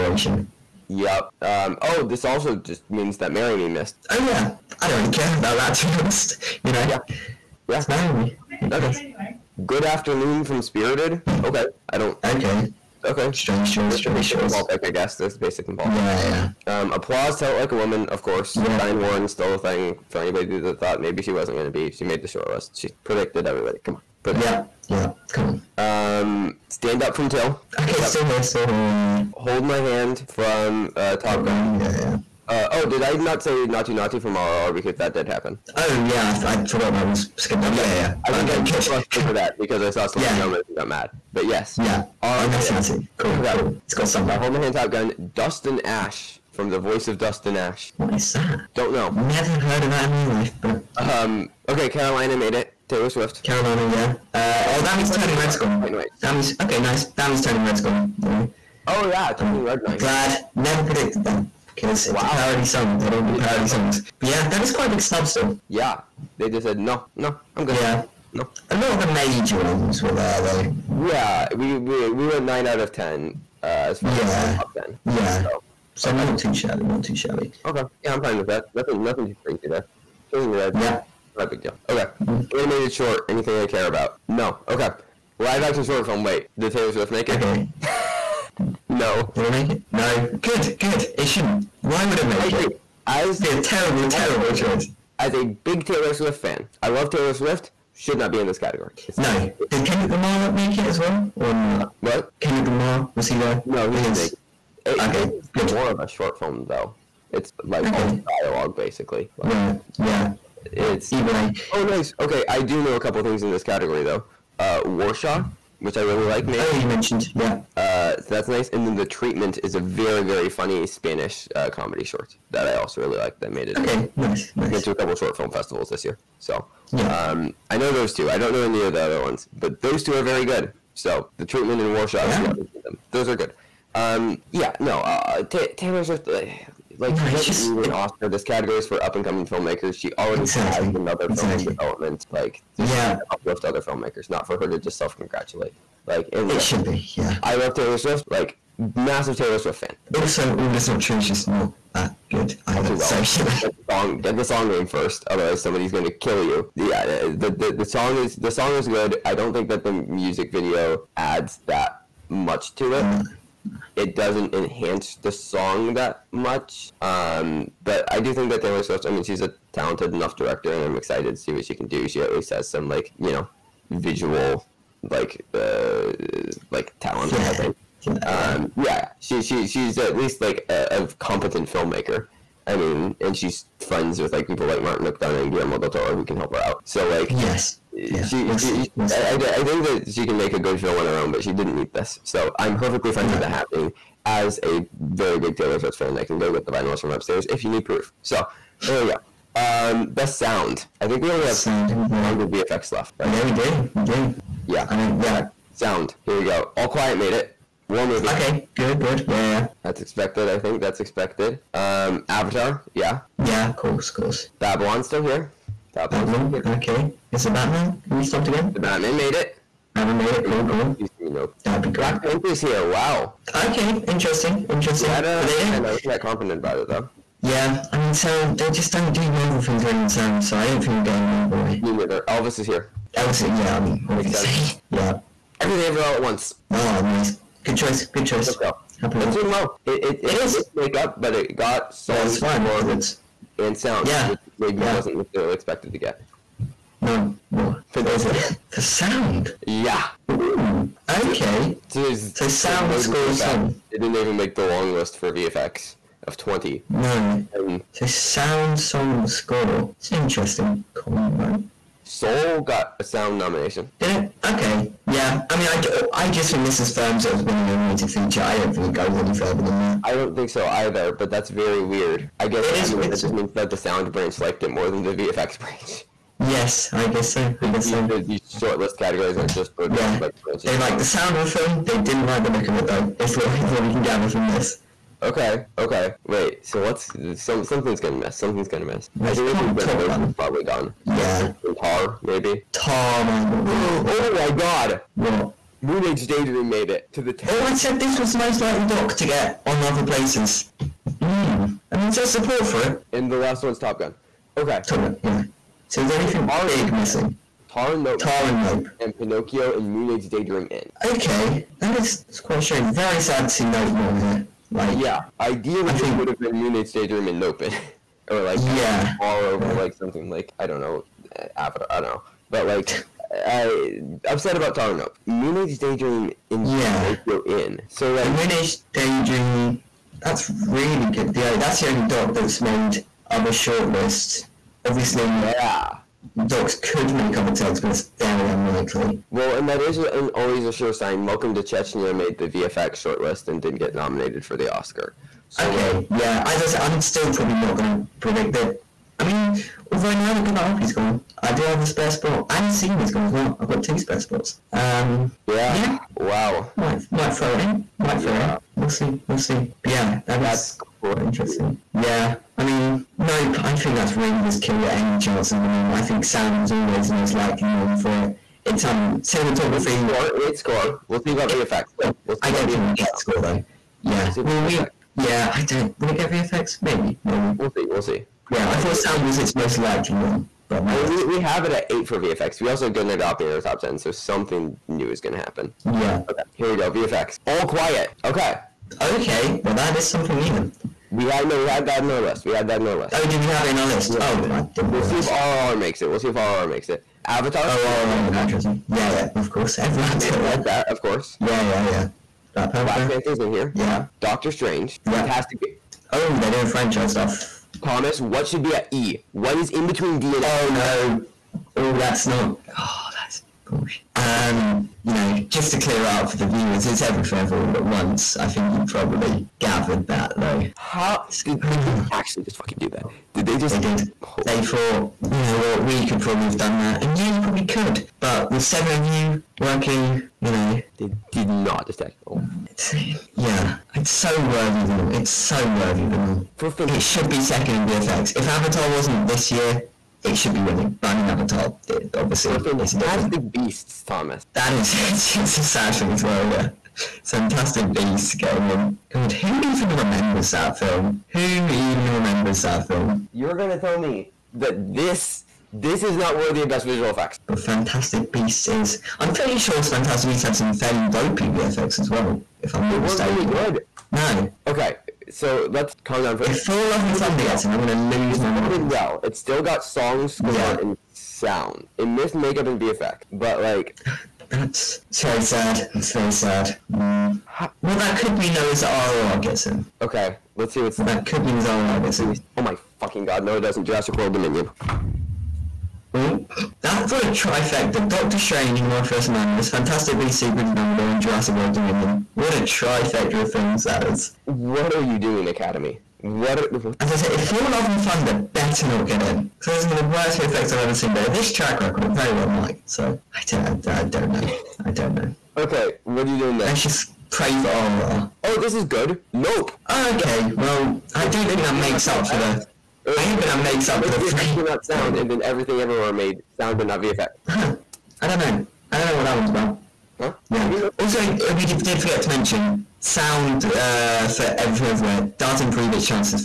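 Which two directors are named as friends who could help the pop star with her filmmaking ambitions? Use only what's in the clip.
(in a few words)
Martin McDonagh and Guillermo del Toro.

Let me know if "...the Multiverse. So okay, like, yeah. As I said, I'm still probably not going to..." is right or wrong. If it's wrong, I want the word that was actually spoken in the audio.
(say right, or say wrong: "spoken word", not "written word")
wrong: "Oscar", not "Multiverse".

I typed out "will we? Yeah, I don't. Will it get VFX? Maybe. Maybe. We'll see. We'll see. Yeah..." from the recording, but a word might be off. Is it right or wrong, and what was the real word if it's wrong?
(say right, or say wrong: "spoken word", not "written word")
right.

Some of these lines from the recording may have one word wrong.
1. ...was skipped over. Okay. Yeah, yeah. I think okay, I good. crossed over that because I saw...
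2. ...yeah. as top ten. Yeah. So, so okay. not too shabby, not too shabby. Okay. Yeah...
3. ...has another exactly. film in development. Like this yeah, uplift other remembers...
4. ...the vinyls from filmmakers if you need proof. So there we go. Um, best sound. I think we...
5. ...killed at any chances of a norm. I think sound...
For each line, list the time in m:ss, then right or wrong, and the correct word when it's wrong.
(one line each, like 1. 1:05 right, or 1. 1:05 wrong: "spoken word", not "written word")
1. 0:37 right
2. 1:14 right
3. 2:20 wrong: "filmmakers", not "remembers"
4. 3:16 wrong: "upstairs", not "filmmakers"
5. 6:04 right.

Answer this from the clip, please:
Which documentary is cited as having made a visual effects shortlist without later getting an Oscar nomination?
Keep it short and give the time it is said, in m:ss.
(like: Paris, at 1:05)
Welcome to Chechnya, at 5:41.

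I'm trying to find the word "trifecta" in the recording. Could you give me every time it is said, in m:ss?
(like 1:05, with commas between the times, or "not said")
8:07, 8:12.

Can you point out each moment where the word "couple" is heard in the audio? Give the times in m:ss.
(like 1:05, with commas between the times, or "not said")
1:52, 2:04.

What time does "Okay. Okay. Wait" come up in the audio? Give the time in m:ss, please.
4:45.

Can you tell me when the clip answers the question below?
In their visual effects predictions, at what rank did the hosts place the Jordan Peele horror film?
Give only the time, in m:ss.
6:21.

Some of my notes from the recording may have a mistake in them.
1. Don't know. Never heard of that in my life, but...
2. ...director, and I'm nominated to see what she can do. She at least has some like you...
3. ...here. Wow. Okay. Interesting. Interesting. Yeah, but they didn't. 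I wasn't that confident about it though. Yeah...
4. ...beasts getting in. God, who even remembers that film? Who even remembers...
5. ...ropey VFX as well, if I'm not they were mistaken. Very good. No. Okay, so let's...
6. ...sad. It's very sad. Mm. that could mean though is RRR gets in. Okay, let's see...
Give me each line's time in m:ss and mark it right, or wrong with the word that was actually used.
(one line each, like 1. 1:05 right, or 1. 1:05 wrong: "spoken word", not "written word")
1. 0:48 right
2. 2:50 wrong: "excited", not "nominated"
3. 3:42 right
4. 7:27 right
5. 7:41 right
6. 7:55 right.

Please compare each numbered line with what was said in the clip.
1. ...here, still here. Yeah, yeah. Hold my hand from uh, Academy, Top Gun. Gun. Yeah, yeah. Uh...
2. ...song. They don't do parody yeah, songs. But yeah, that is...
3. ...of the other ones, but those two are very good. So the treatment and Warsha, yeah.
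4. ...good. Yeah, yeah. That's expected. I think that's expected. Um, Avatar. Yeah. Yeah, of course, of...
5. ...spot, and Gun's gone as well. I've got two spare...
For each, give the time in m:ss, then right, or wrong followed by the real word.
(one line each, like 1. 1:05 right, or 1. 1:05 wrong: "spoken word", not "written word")
1. 0:28 wrong: "Top", not "Academy"
2. 1:02 right
3. 2:08 right
4. 3:28 right
5. 5:52 wrong: "Senior", not "Gun".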